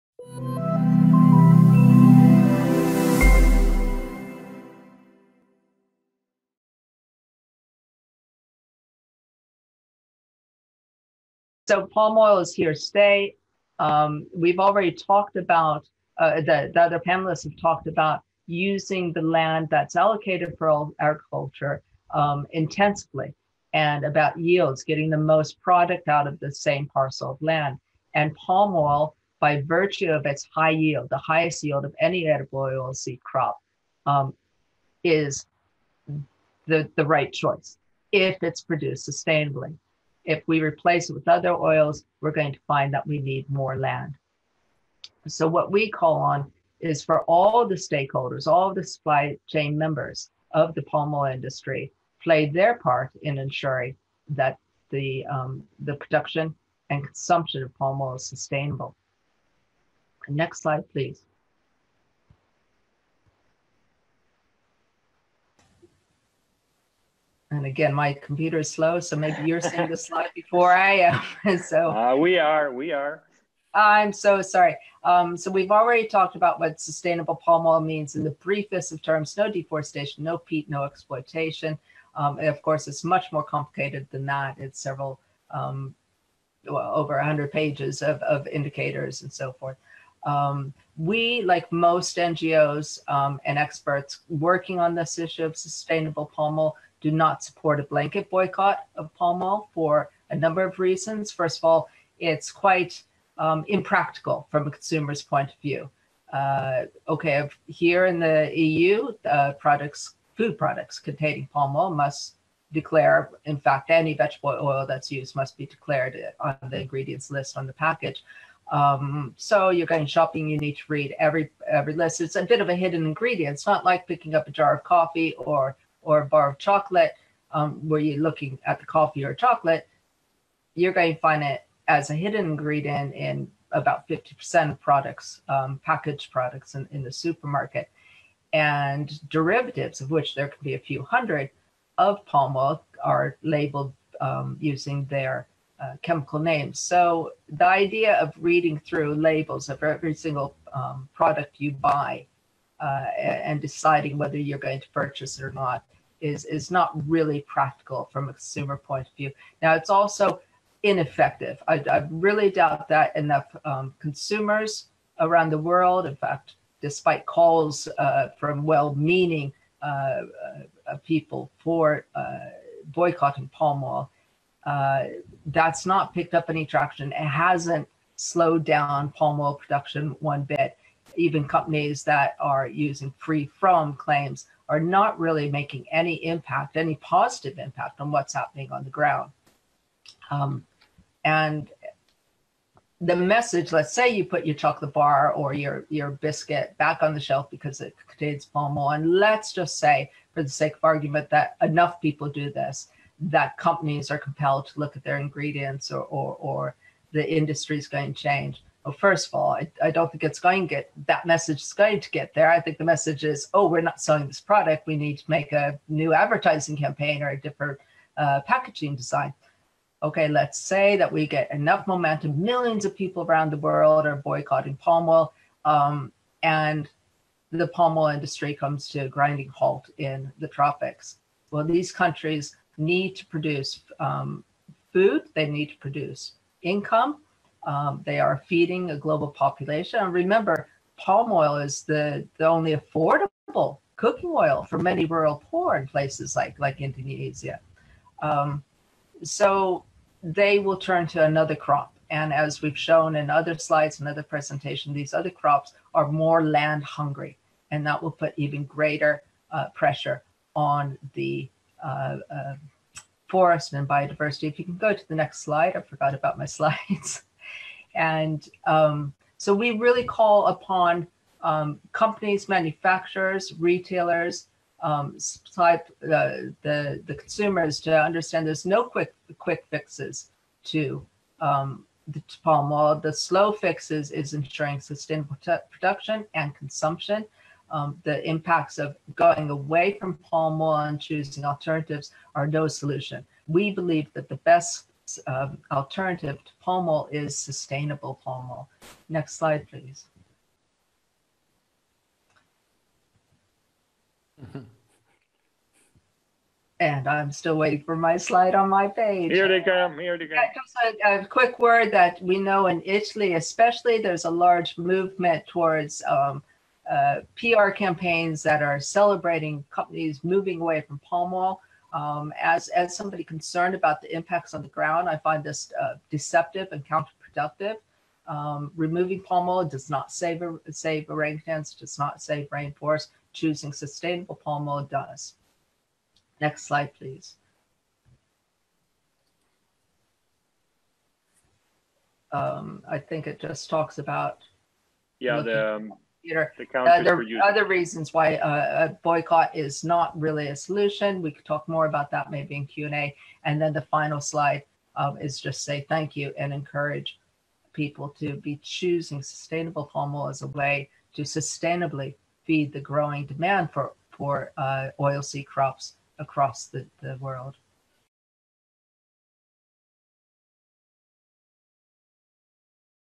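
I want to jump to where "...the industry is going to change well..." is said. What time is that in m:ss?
3:27.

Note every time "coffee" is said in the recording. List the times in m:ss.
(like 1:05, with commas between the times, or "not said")
2:04, 2:08.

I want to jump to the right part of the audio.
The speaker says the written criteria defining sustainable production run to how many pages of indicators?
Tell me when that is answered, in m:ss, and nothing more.
1:26.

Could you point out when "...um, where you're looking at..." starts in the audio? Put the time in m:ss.
2:07.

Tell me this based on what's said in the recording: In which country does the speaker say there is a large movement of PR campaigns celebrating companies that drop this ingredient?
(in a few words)
Italy.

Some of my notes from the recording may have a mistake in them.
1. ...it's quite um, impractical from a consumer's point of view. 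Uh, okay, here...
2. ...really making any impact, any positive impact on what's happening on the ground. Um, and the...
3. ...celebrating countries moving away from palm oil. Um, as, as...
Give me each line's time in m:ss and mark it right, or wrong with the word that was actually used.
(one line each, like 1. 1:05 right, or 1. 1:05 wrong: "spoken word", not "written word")
1. 1:42 right
2. 3:05 right
3. 5:18 wrong: "companies", not "countries".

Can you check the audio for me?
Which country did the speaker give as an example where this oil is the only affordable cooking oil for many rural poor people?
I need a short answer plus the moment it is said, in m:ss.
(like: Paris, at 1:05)
Indonesia, at 4:06.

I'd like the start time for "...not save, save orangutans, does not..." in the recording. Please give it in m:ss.
5:29.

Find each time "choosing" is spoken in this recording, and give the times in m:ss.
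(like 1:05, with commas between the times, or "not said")
4:50, 5:33, 5:58.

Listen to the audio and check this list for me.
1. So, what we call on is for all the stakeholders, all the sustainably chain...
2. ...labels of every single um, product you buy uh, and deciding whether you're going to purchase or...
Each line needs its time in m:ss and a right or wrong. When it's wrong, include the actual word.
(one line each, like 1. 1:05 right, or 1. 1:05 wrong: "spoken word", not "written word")
1. 0:45 wrong: "supply", not "sustainably"
2. 2:29 right.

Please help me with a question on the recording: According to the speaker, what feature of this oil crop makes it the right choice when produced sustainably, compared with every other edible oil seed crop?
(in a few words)
highest yield.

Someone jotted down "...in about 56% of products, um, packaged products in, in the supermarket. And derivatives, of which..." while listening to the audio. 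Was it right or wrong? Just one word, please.
wrong.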